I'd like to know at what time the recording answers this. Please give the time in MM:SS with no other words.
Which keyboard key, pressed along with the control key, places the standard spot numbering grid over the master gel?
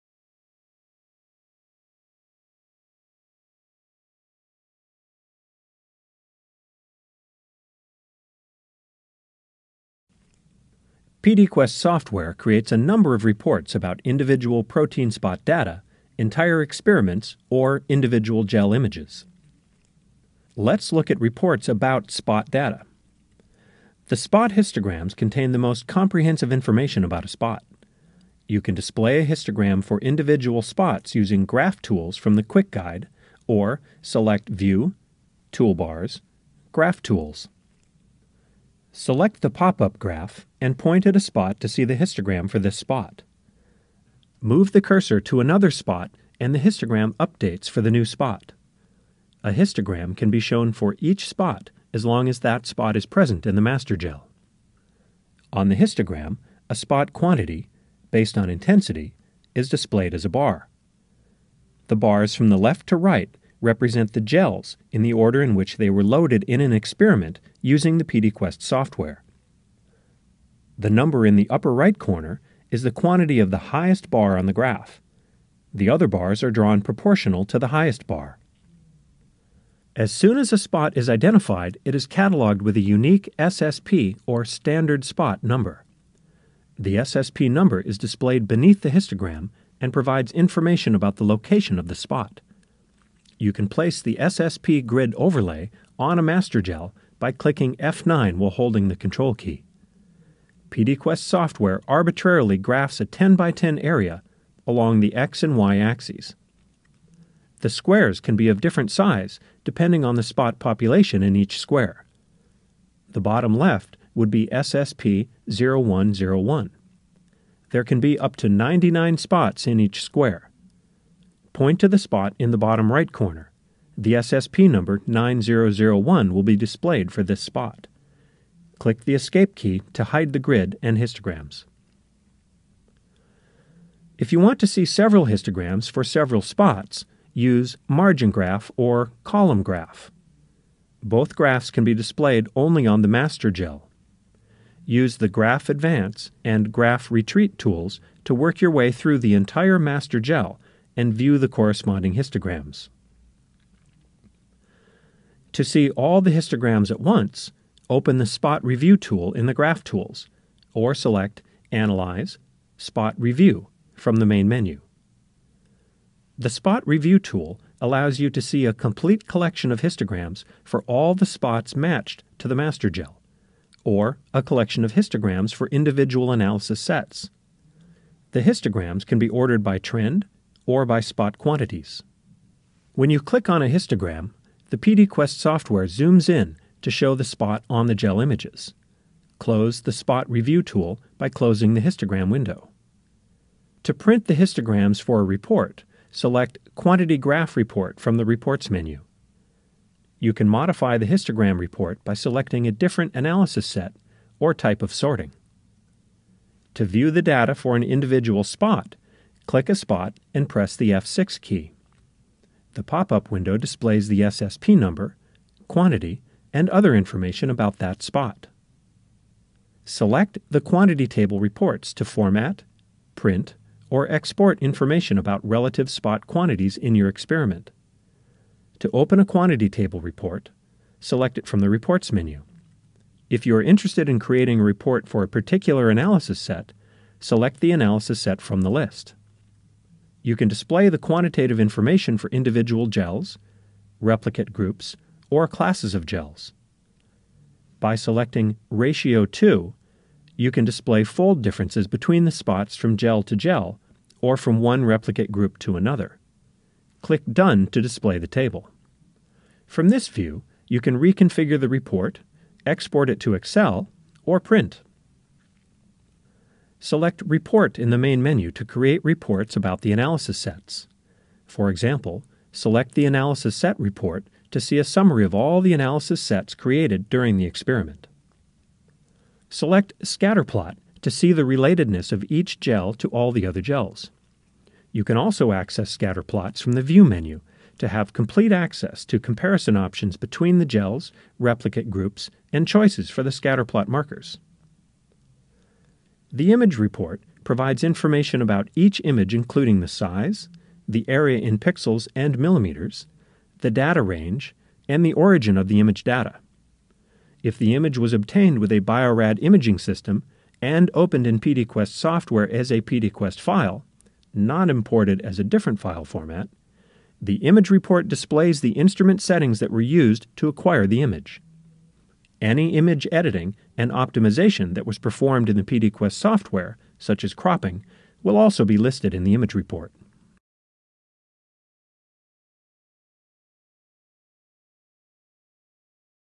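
01:37.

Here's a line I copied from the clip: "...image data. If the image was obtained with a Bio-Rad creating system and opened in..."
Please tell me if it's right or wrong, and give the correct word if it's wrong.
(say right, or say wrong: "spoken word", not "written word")
wrong: "imaging", not "creating".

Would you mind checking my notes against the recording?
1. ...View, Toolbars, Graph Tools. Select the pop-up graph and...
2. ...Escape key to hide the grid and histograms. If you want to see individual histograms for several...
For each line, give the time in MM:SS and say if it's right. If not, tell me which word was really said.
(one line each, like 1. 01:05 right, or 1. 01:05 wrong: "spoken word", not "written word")
1. 00:34 right
2. 02:09 wrong: "several", not "individual".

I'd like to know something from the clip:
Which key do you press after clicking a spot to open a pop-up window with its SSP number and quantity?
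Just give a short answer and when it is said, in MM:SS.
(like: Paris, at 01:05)
F6, at 03:30.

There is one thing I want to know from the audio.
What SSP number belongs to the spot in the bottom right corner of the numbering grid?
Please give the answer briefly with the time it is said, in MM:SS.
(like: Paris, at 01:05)
9001, at 02:05.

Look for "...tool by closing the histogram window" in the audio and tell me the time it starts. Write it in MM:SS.
03:10.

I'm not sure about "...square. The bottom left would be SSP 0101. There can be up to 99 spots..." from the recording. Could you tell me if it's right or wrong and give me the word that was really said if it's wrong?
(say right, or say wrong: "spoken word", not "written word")
right.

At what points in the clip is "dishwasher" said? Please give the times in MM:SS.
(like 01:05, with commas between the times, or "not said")
not said.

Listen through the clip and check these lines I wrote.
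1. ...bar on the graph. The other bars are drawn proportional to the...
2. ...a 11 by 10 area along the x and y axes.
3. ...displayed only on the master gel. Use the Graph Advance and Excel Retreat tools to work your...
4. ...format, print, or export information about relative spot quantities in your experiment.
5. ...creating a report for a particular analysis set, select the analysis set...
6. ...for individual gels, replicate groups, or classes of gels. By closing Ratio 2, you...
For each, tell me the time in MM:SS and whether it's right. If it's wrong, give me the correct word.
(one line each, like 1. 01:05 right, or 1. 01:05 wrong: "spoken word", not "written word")
1. 01:14 right
2. 01:42 wrong: "10", not "11"
3. 02:21 wrong: "Graph", not "Excel"
4. 03:42 right
5. 03:54 right
6. 04:02 wrong: "selecting", not "closing".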